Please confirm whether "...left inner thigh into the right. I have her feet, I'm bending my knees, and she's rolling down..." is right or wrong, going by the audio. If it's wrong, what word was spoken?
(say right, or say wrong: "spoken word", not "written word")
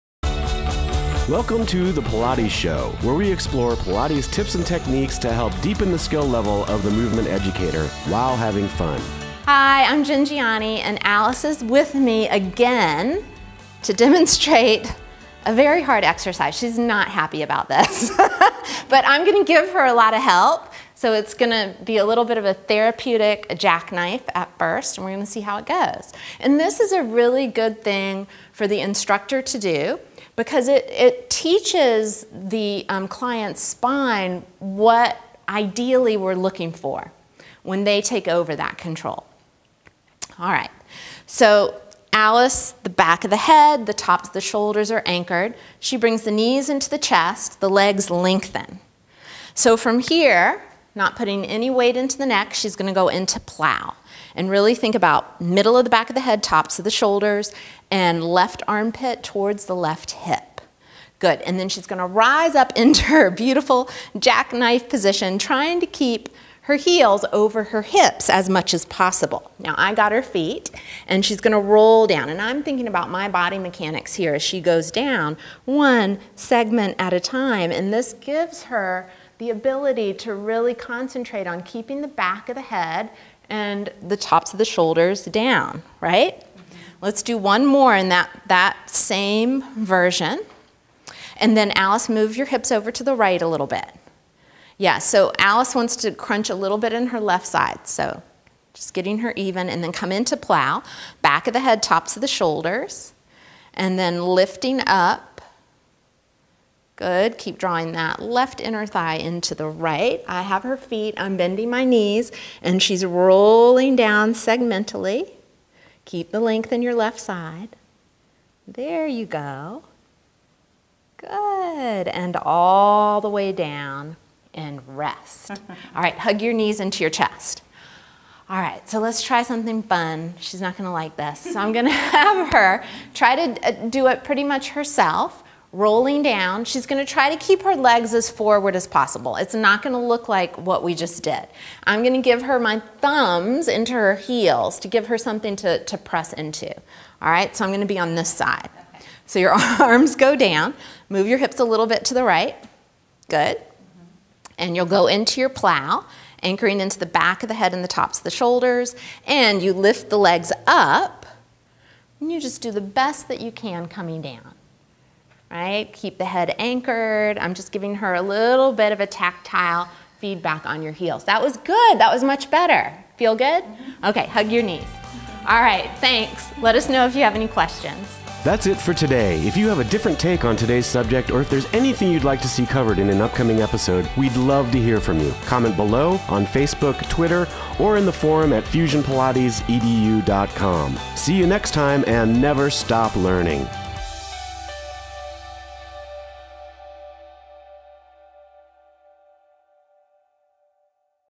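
right.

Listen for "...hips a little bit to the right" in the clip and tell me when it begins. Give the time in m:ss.
2:31.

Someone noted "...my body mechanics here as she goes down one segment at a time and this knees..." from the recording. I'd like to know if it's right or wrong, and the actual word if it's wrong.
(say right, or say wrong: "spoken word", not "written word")
wrong: "gives", not "knees".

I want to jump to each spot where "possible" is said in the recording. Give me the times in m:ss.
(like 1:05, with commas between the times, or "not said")
1:08, 2:18.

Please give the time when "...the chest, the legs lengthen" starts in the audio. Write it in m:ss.
0:46.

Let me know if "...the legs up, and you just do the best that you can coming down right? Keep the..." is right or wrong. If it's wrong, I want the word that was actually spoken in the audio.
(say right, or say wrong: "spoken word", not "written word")
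right.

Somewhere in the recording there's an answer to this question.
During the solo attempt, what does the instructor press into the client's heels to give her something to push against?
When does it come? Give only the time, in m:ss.
2:22.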